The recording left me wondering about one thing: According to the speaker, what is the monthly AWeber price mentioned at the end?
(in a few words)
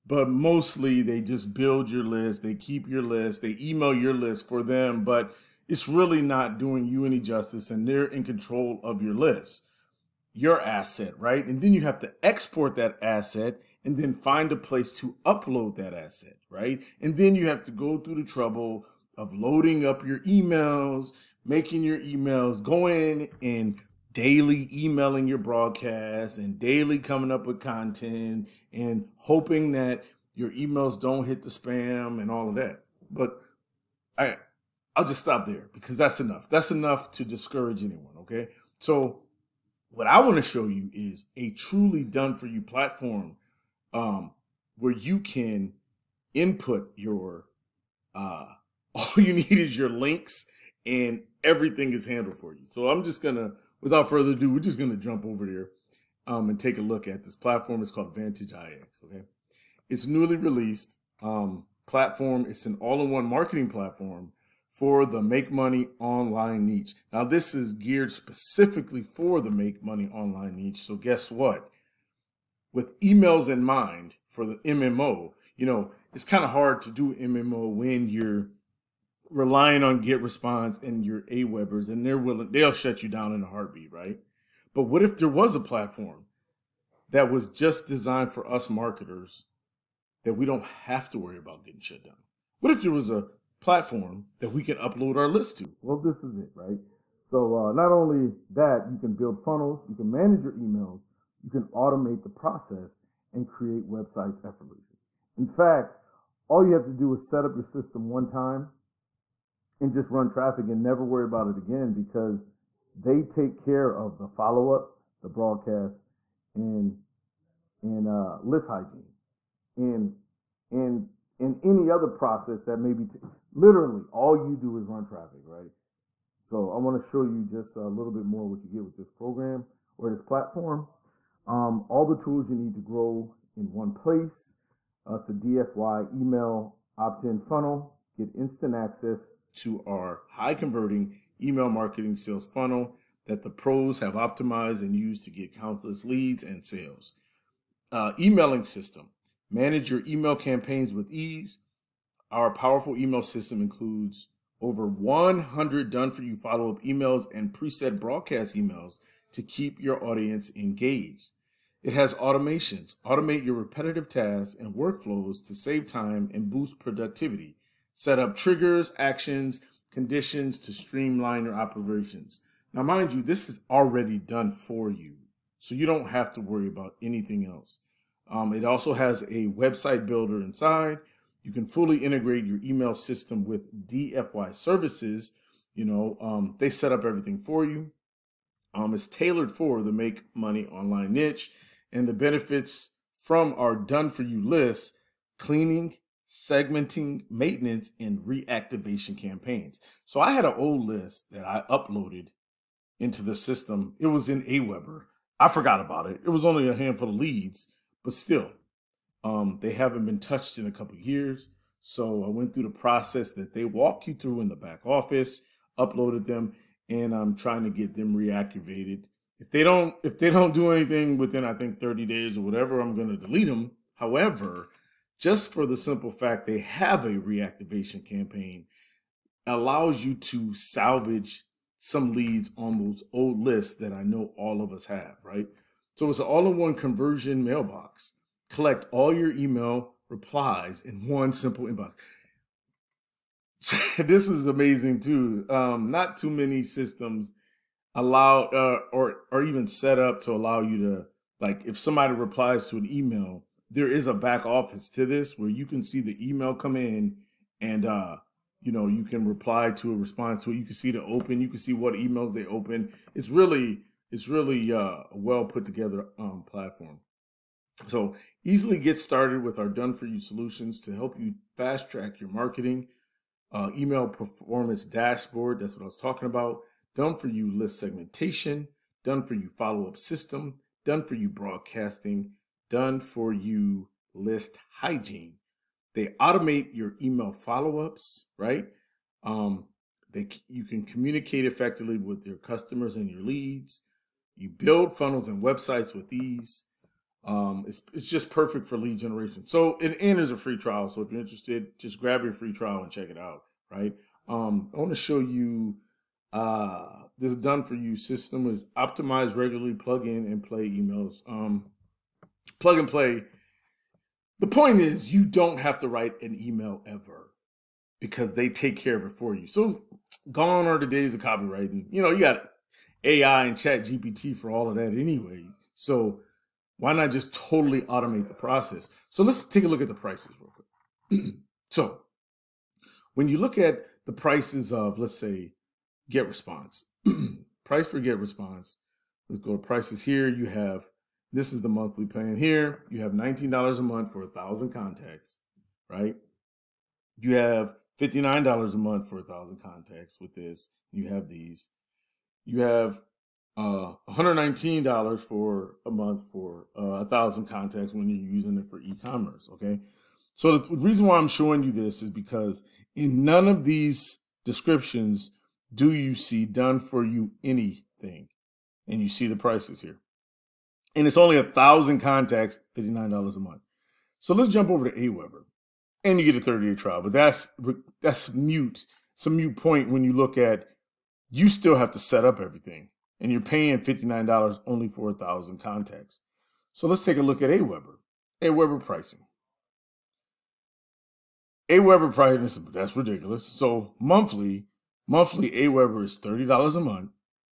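$30.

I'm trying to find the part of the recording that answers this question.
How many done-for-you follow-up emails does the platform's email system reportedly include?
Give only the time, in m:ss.
2:34.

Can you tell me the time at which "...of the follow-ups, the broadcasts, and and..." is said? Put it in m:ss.
1:53.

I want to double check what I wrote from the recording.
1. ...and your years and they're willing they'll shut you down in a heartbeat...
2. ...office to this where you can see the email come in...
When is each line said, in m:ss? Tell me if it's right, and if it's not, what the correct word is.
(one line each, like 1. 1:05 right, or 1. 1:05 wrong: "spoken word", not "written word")
1. 1:20 wrong: "webers", not "years"
2. 4:14 right.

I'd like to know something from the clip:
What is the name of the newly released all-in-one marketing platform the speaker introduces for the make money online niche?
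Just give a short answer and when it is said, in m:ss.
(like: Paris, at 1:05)
Vantage IX, at 0:58.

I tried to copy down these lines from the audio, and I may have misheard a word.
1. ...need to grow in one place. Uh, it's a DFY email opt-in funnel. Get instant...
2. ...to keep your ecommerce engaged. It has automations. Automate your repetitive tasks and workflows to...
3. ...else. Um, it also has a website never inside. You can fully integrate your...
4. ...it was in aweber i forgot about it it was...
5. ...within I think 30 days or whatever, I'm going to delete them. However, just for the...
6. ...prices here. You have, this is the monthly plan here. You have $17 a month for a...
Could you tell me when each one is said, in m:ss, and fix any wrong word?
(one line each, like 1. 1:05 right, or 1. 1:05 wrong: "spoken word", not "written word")
1. 2:12 right
2. 2:39 wrong: "audience", not "ecommerce"
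3. 2:57 wrong: "builder", not "never"
4. 3:23 right
5. 3:41 right
6. 5:39 wrong: "19", not "17".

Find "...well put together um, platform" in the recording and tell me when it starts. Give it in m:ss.
4:25.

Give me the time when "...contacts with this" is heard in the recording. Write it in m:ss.
5:49.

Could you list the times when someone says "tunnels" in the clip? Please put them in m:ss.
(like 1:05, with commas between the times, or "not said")
not said.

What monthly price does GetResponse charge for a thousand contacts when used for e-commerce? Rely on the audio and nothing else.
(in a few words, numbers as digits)
$119.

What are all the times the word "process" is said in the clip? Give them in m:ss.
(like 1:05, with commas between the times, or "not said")
1:42, 2:02, 3:32, 5:28.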